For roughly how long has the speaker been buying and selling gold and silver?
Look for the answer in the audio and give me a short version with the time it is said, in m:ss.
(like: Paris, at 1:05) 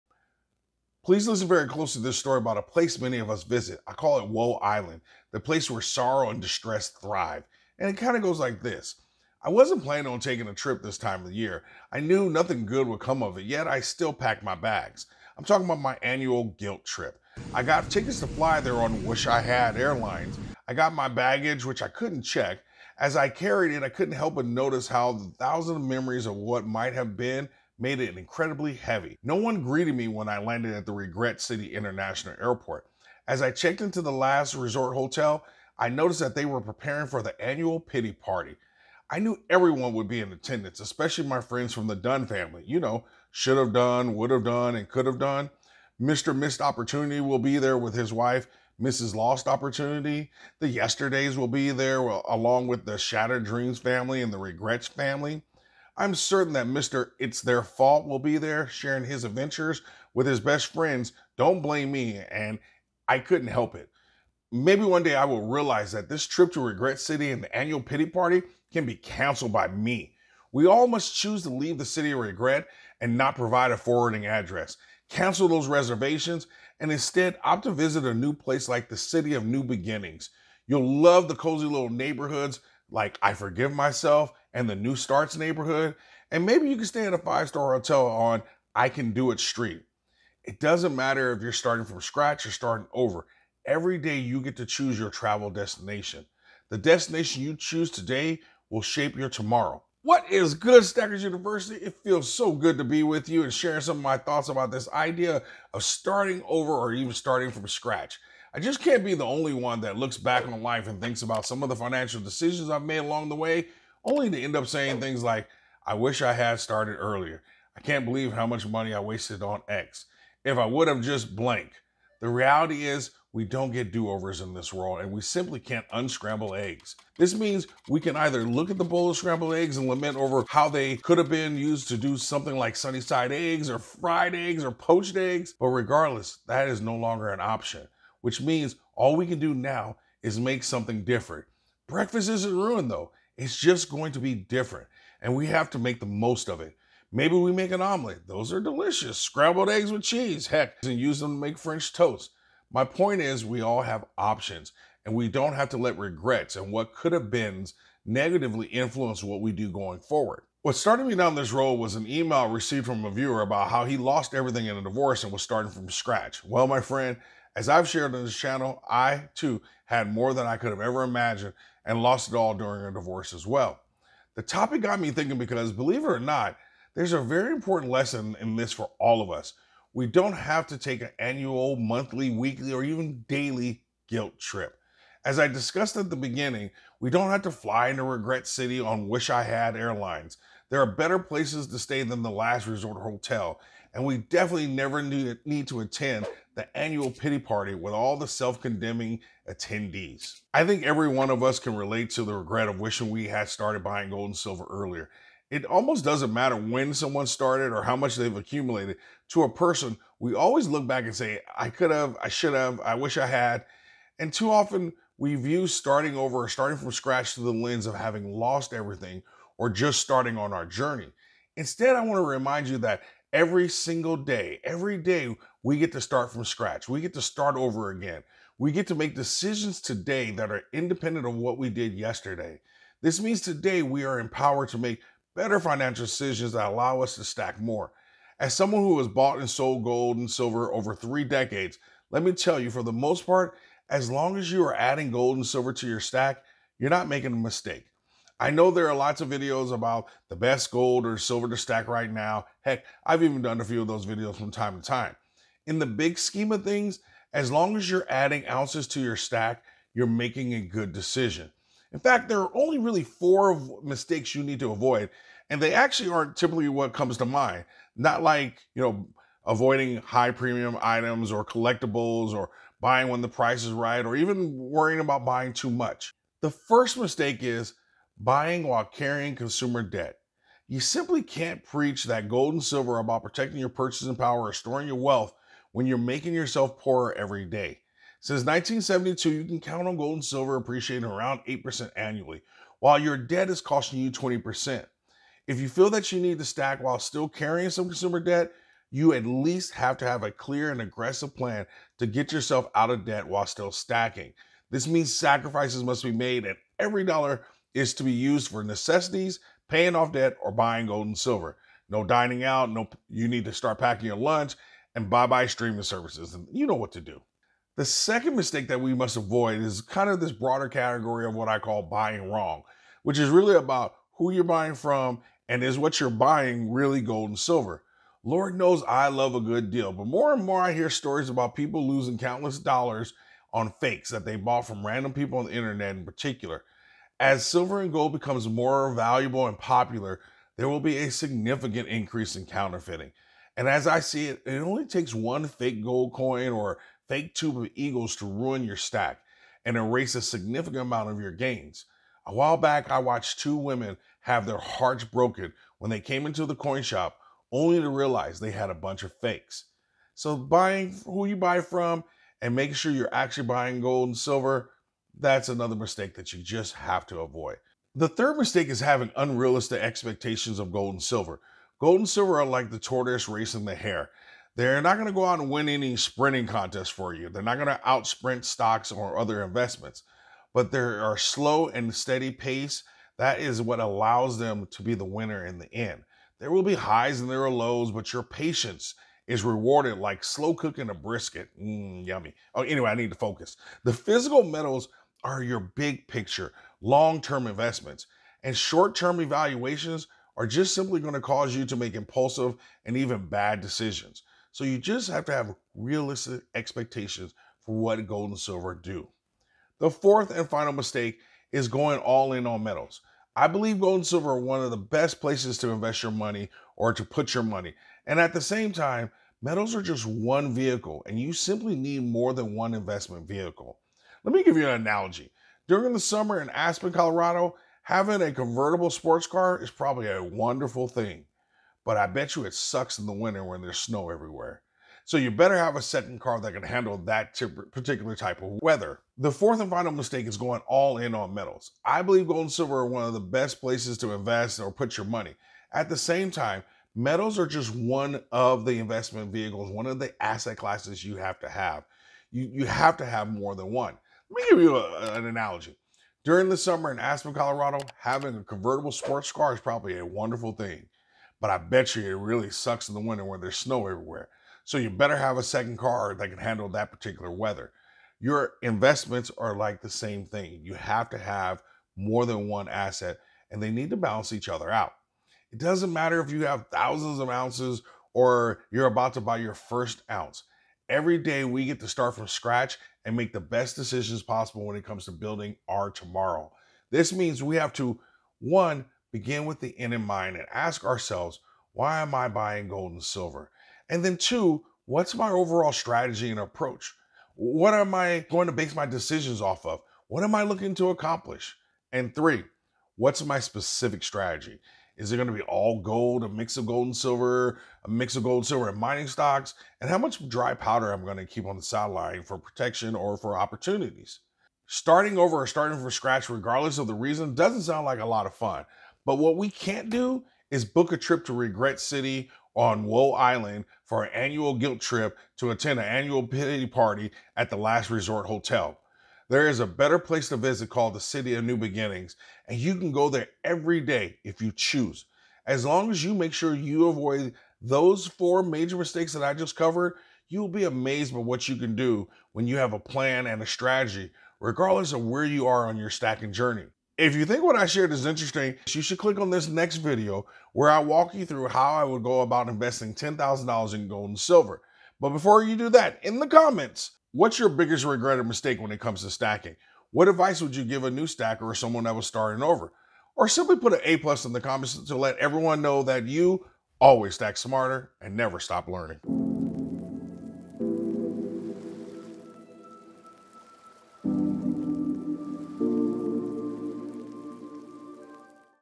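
three decades, at 4:00.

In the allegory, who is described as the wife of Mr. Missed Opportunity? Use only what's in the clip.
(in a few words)
Mrs. Lost Opportunity.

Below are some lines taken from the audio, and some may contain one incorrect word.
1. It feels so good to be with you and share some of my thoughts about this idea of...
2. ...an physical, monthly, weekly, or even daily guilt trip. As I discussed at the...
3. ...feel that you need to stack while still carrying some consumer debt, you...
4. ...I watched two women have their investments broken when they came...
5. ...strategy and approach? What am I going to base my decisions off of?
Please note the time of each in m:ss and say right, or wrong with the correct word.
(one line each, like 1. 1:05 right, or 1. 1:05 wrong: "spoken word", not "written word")
1. 1:41 right
2. 3:01 wrong: "annual", not "physical"
3. 4:55 right
4. 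5:52 wrong: "hearts", not "investments"
5. 8:15 right.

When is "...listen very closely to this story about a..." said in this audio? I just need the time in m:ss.
0:01.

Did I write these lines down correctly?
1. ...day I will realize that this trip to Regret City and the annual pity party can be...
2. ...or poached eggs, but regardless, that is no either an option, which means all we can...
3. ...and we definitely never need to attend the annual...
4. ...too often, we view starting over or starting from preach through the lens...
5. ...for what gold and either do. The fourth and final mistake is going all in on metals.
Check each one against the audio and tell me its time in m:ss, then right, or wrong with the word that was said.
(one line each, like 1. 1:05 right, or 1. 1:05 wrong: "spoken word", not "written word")
1. 1:05 right
2. 2:14 wrong: "longer", not "either"
3. 3:13 right
4. 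3:34 wrong: "scratch", not "preach"
5. 6:47 wrong: "silver", not "either".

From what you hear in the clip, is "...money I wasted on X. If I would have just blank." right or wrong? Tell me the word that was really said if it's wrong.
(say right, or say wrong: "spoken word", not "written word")
right.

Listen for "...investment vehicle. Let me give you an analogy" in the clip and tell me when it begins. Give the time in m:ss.
7:02.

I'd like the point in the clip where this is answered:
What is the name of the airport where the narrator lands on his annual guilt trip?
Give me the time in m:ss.
0:30.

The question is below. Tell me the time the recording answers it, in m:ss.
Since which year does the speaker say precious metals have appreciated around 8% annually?
4:48.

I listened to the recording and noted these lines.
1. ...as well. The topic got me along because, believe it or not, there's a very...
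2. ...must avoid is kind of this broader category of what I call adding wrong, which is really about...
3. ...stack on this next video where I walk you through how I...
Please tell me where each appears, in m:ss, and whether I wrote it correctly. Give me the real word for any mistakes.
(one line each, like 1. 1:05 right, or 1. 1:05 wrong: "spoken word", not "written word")
1. 2:53 wrong: "thinking", not "along"
2. 5:18 wrong: "buying", not "adding"
3. 9:08 wrong: "click", not "stack".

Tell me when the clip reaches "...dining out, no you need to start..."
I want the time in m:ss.
5:12.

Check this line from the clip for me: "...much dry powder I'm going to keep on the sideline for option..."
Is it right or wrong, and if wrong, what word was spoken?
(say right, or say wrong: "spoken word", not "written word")
wrong: "protection", not "option".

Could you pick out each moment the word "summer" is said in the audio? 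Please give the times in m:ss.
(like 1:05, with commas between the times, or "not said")
7:05, 7:36.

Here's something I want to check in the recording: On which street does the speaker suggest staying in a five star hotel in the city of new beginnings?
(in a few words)
I Can Do It Street.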